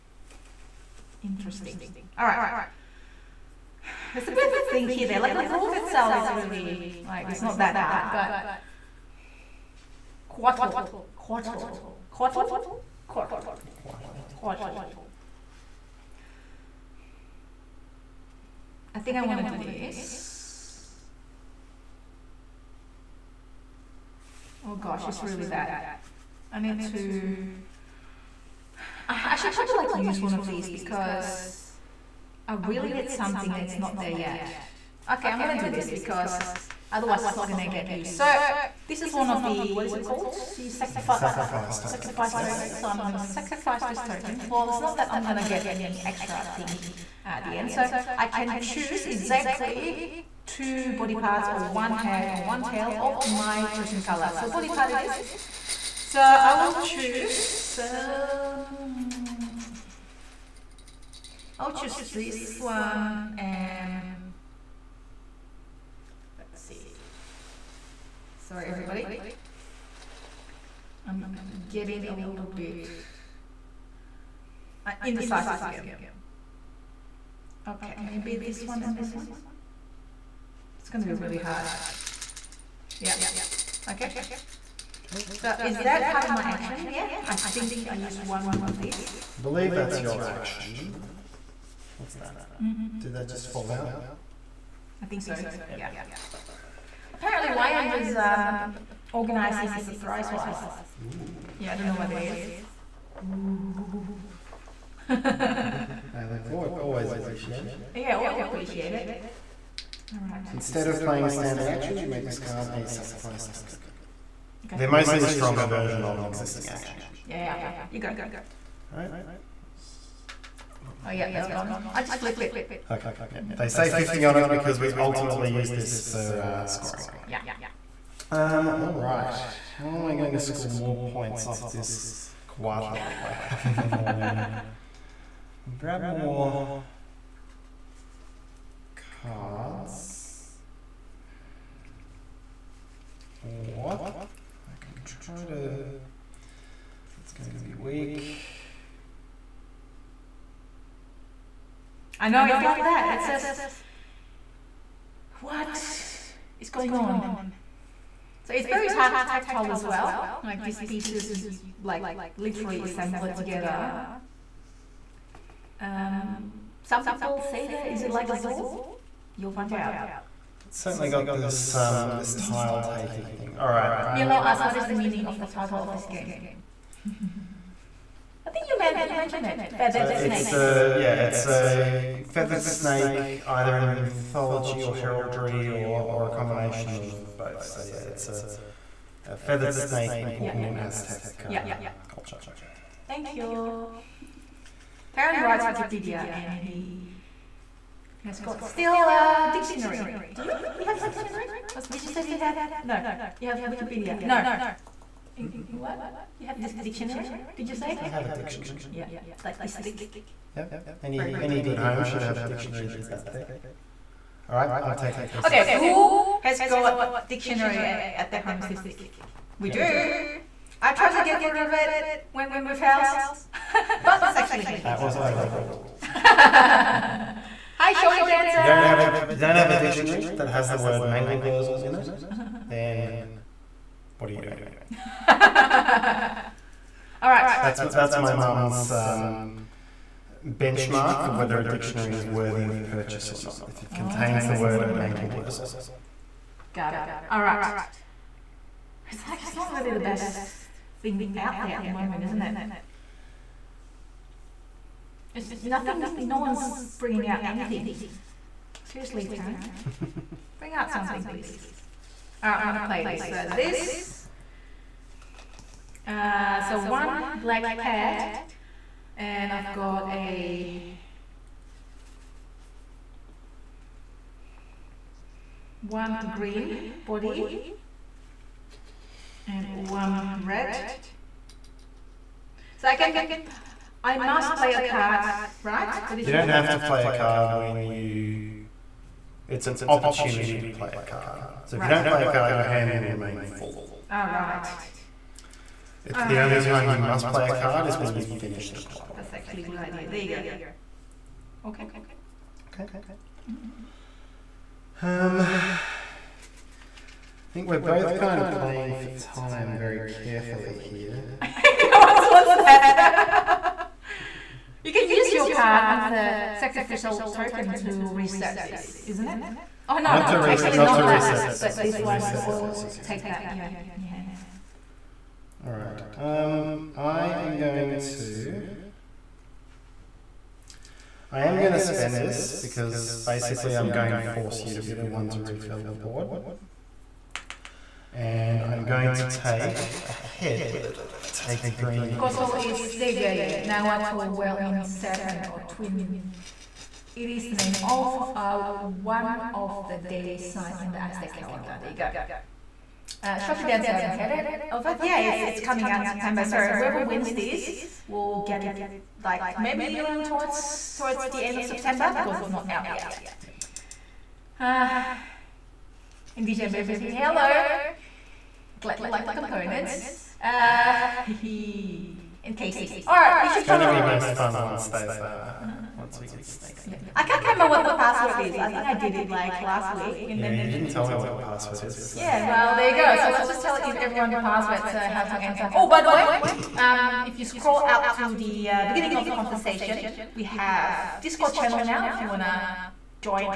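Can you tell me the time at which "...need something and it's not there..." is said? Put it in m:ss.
0:32.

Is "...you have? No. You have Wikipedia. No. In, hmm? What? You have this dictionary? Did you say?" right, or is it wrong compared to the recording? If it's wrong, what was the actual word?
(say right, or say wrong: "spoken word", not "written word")
right.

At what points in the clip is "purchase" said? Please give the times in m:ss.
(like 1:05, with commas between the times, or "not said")
4:02.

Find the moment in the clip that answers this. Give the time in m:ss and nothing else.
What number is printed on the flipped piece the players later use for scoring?
2:03.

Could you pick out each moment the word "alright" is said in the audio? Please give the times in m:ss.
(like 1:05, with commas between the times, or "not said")
1:58, 2:08, 4:22.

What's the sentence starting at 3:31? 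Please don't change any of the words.
any good home should have a dictionary that's that thick.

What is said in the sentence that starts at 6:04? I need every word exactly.
Uh, and DJ Murphy say hello glad you like the components.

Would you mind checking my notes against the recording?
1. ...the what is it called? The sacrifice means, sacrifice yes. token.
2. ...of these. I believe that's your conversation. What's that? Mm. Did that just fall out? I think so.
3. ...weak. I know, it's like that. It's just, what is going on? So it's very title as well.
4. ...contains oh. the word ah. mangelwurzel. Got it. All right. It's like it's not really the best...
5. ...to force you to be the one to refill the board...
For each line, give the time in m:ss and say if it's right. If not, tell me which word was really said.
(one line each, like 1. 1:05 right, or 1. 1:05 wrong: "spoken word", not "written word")
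1. 0:39 wrong: "tokens", not "means"
2. 1:28 wrong: "action", not "conversation"
3. 2:27 wrong: "tactile", not "title"
4. 4:03 right
5. 5:34 right.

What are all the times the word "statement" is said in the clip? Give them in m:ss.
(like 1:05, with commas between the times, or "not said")
not said.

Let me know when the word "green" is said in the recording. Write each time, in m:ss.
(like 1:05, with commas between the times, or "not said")
4:36, 5:41.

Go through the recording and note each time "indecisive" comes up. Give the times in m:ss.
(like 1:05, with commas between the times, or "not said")
1:15.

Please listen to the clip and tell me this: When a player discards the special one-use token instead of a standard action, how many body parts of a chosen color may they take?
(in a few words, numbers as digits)
2.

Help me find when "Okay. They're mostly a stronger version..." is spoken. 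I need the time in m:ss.
1:54.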